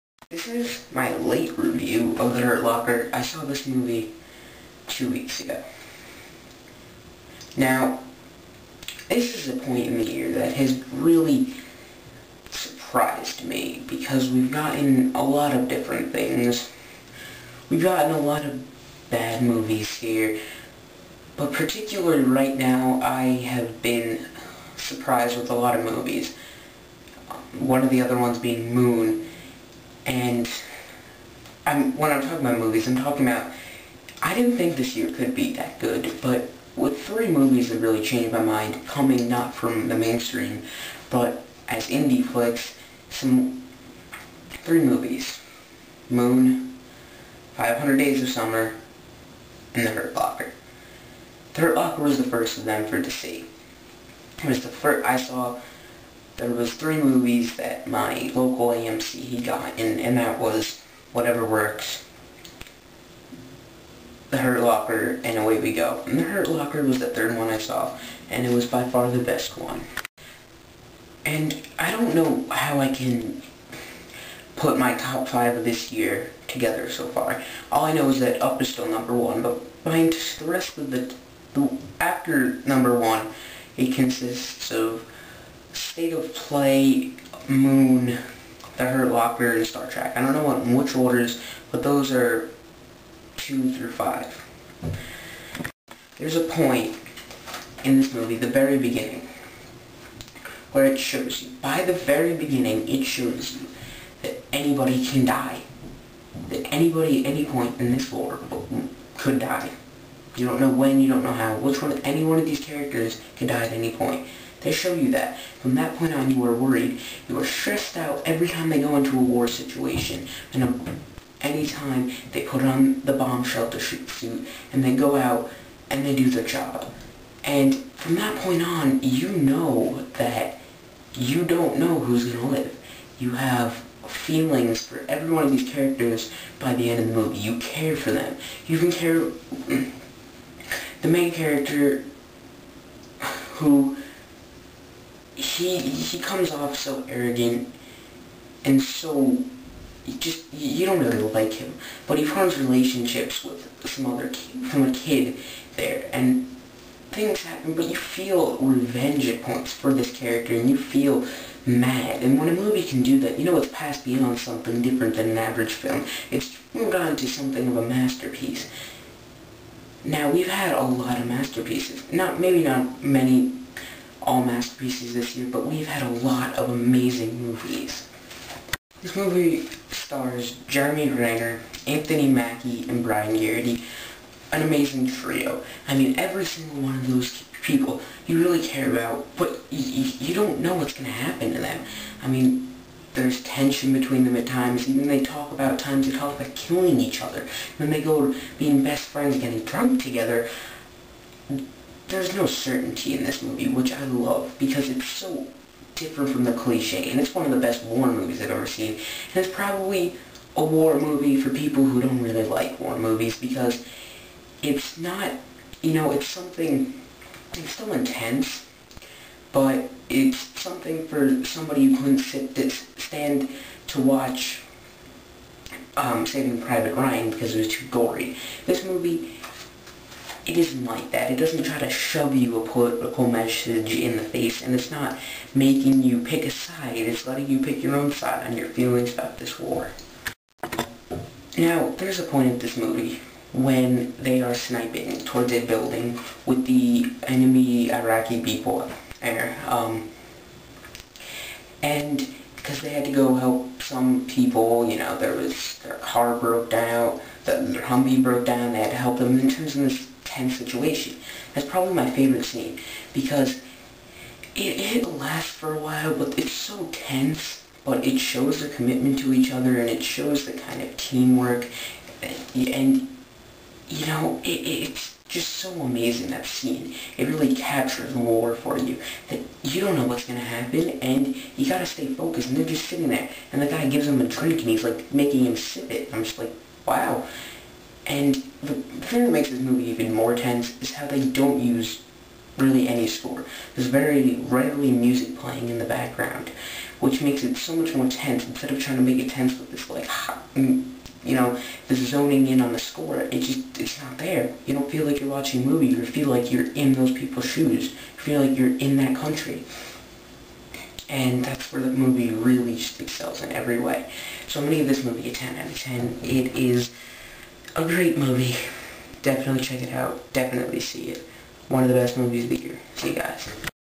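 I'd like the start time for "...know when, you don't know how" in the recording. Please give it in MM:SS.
01:50.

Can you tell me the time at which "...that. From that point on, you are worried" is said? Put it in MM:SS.
01:55.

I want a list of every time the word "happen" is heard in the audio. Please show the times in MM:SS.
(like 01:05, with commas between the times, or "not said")
02:37, 03:11, 04:40.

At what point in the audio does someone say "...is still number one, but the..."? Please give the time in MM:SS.
01:18.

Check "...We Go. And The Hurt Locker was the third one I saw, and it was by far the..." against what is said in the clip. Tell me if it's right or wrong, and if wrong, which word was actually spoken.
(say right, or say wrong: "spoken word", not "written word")
right.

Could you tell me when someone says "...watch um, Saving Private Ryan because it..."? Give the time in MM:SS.
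03:44.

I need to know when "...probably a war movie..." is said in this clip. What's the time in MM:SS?
03:29.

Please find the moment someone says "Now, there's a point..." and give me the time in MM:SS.
04:01.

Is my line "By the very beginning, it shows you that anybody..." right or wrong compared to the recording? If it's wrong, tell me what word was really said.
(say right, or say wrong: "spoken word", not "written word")
right.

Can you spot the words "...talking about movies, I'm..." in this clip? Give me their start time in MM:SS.
00:32.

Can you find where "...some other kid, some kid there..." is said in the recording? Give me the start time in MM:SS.
02:33.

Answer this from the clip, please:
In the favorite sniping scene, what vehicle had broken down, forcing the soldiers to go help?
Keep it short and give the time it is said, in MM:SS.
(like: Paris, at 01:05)
Humvee, at 04:17.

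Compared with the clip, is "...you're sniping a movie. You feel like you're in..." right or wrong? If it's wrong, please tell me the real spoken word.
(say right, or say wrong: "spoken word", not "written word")
wrong: "watching", not "sniping".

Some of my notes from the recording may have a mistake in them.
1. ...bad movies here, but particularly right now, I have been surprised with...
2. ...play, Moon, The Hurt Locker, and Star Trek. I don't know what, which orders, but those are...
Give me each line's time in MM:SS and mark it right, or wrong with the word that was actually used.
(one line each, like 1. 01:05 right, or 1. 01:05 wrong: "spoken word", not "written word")
1. 00:19 right
2. 01:26 right.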